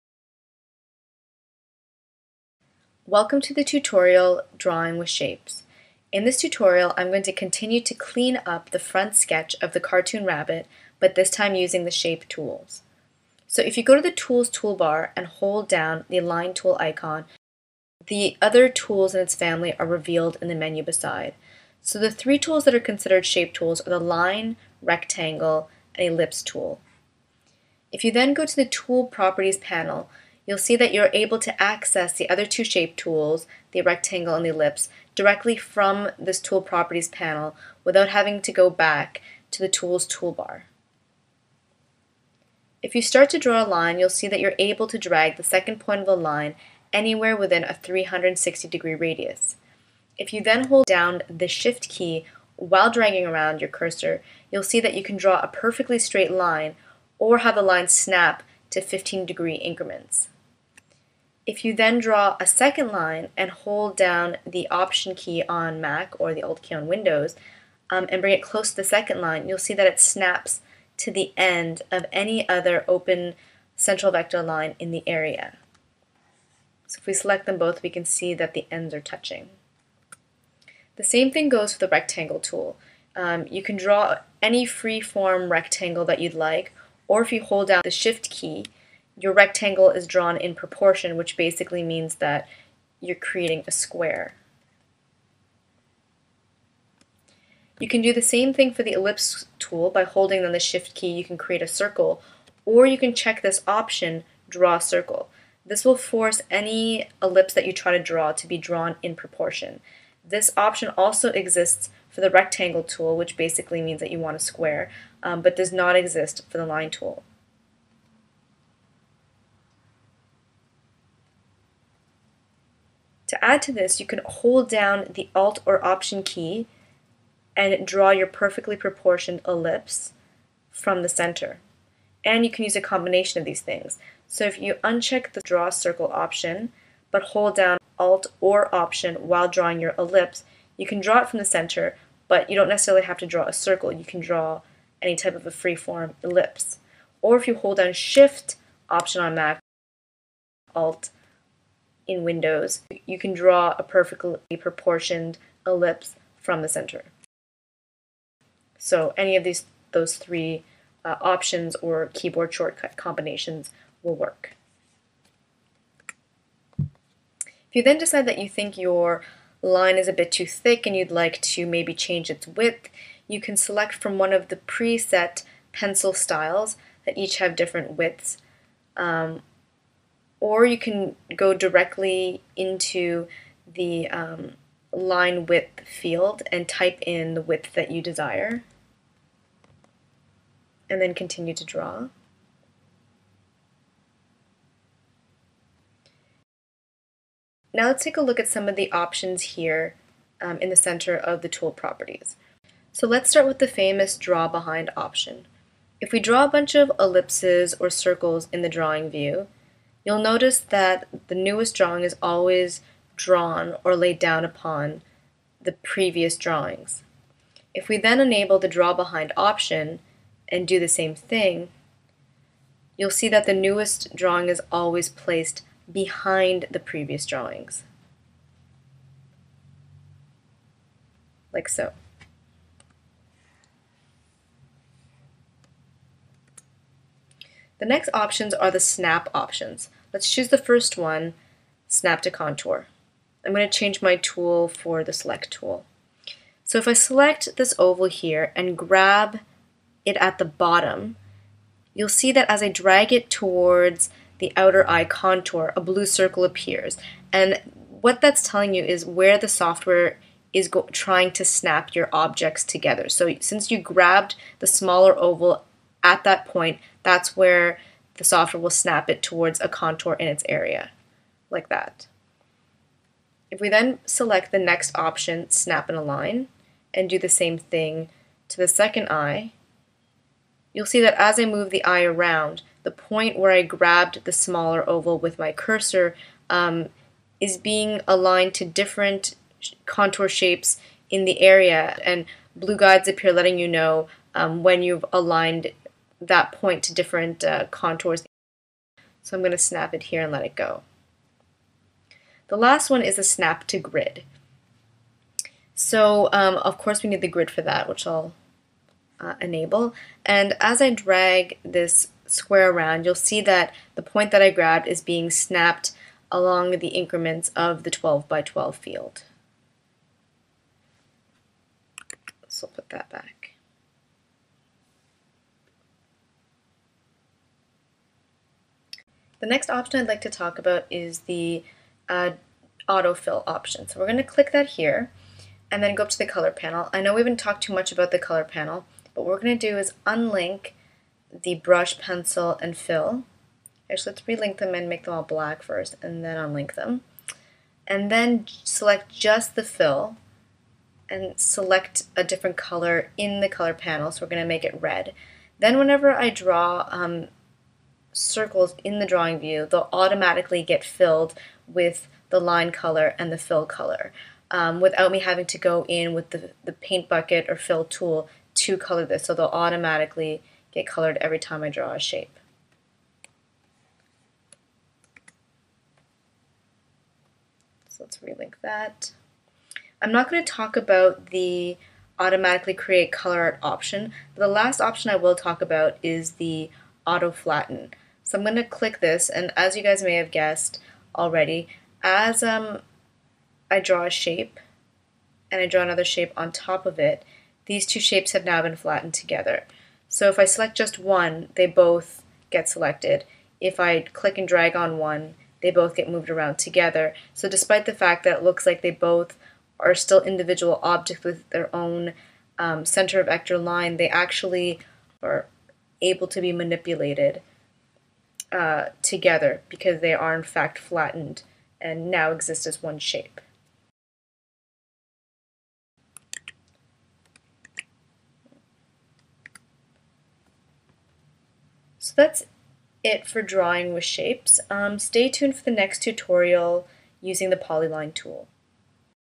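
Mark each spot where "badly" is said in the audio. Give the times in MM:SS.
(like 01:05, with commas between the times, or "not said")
not said.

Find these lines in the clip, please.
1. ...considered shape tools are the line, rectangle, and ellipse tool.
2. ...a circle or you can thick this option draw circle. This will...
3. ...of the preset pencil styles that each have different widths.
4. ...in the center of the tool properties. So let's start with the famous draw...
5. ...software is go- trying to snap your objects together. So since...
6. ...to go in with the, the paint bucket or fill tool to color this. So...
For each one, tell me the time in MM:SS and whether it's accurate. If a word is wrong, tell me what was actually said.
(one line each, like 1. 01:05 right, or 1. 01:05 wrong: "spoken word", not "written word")
1. 00:22 right
2. 01:41 wrong: "check", not "thick"
3. 02:54 right
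4. 03:20 right
5. 04:19 right
6. 06:05 right.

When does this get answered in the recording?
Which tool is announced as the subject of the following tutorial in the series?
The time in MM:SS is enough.
07:17.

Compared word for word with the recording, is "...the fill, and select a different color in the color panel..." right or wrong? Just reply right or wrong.
right.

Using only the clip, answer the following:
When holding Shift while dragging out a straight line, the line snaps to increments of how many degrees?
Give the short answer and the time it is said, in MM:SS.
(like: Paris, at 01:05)
15, at 00:58.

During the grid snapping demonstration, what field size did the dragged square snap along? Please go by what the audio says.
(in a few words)
12 by 12.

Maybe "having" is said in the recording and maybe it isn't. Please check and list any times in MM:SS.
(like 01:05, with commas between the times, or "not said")
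00:38, 06:05.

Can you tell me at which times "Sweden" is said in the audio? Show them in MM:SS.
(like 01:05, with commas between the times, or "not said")
not said.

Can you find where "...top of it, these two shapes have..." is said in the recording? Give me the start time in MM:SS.
06:36.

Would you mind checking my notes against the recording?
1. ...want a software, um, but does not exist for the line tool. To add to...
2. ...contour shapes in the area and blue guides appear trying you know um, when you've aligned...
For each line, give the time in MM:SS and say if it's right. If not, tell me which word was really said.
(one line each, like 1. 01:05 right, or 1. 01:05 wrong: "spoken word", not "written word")
1. 01:54 wrong: "square", not "software"
2. 04:49 wrong: "letting", not "trying".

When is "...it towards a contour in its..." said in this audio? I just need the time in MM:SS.
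04:29.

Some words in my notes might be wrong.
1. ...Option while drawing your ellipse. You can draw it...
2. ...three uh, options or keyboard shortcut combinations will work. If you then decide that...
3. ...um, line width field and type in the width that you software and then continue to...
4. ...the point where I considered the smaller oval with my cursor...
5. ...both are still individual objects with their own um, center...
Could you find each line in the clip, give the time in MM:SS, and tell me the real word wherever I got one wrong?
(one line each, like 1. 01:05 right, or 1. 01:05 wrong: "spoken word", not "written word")
1. 02:18 right
2. 02:40 right
3. 03:04 wrong: "desire", not "software"
4. 04:42 wrong: "grabbed", not "considered"
5. 06:48 right.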